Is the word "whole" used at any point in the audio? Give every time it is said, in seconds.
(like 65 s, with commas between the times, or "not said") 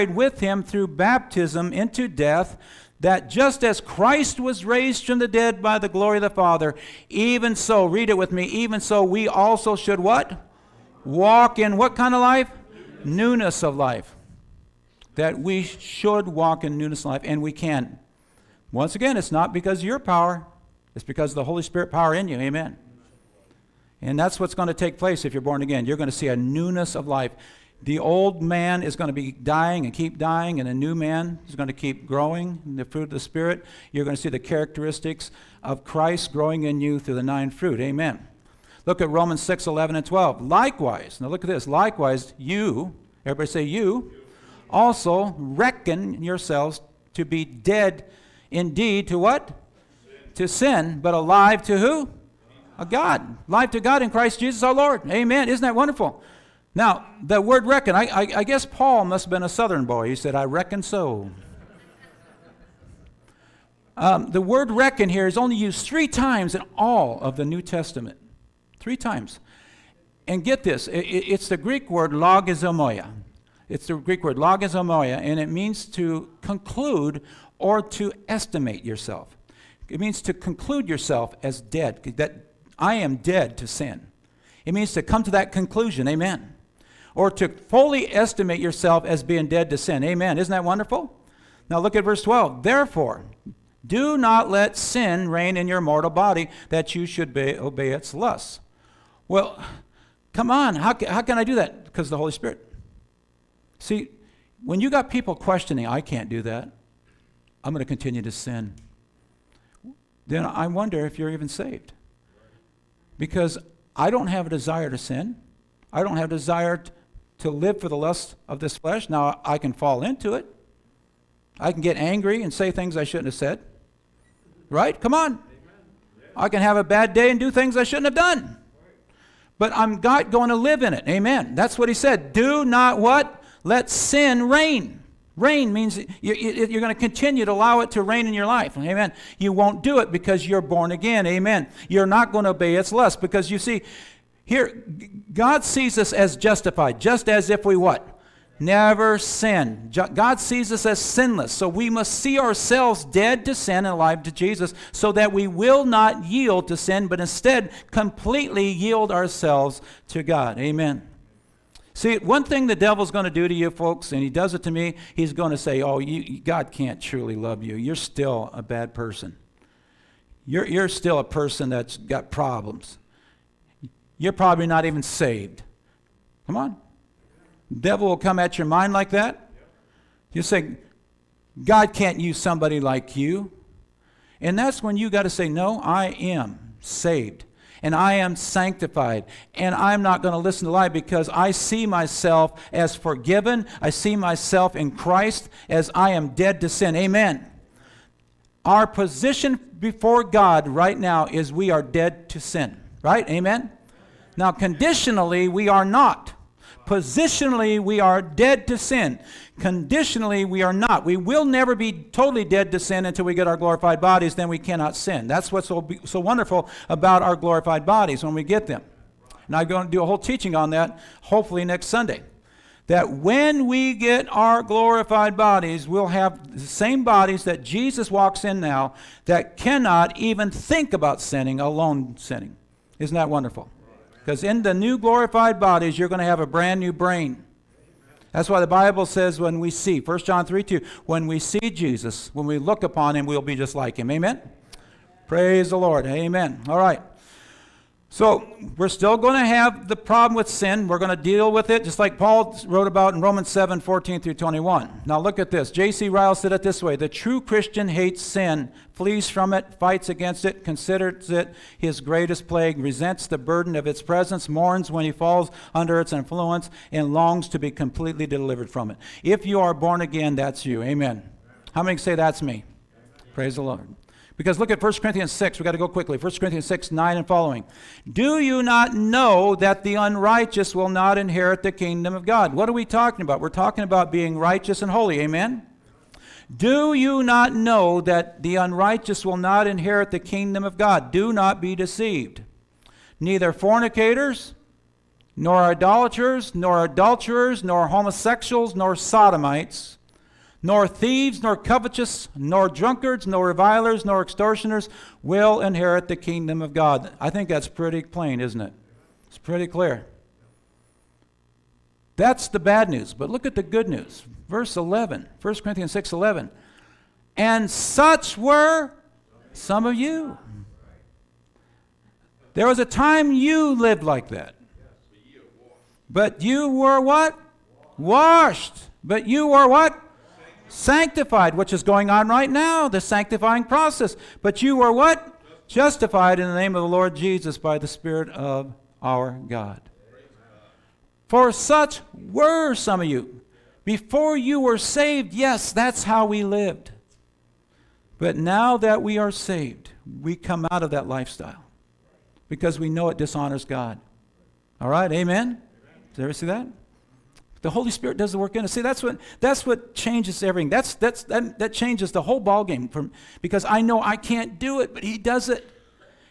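220 s, 362 s.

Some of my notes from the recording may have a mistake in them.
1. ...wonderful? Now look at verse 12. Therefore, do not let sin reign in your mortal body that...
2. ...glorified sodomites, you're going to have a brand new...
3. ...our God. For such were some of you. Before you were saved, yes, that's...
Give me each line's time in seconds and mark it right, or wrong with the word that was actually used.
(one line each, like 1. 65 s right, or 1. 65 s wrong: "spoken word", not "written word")
1. 90 s right
2. 234 s wrong: "bodies", not "sodomites"
3. 339 s right.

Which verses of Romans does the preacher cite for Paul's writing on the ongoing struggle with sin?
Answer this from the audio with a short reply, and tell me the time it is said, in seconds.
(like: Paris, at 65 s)
Romans 7:14-21, at 253 s.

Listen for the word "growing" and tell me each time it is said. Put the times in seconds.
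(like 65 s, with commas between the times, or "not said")
32 s, 36 s.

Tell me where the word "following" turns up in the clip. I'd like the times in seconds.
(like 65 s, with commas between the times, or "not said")
277 s.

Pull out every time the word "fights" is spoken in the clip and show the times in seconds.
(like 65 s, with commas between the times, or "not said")
259 s.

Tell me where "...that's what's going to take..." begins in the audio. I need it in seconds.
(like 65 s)
24 s.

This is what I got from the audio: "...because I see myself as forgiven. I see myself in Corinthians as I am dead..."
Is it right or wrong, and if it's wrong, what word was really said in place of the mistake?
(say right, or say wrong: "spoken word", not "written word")
wrong: "Christ", not "Corinthians".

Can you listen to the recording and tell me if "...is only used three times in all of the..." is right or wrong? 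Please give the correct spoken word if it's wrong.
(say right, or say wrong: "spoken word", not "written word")
right.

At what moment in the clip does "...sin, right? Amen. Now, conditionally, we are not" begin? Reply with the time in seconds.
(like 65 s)
202 s.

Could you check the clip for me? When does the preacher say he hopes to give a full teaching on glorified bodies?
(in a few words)
next Sunday.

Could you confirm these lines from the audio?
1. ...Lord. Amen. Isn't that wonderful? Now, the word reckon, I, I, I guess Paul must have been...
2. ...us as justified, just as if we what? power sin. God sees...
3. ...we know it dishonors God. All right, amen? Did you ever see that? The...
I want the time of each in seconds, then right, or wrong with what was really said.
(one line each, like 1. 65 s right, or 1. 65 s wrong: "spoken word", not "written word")
1. 54 s right
2. 145 s wrong: "never", not "power"
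3. 352 s right.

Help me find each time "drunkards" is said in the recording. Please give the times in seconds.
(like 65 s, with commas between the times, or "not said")
302 s.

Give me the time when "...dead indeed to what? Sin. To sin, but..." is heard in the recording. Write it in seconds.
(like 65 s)
47 s.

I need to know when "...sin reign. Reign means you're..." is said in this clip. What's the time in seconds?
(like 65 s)
133 s.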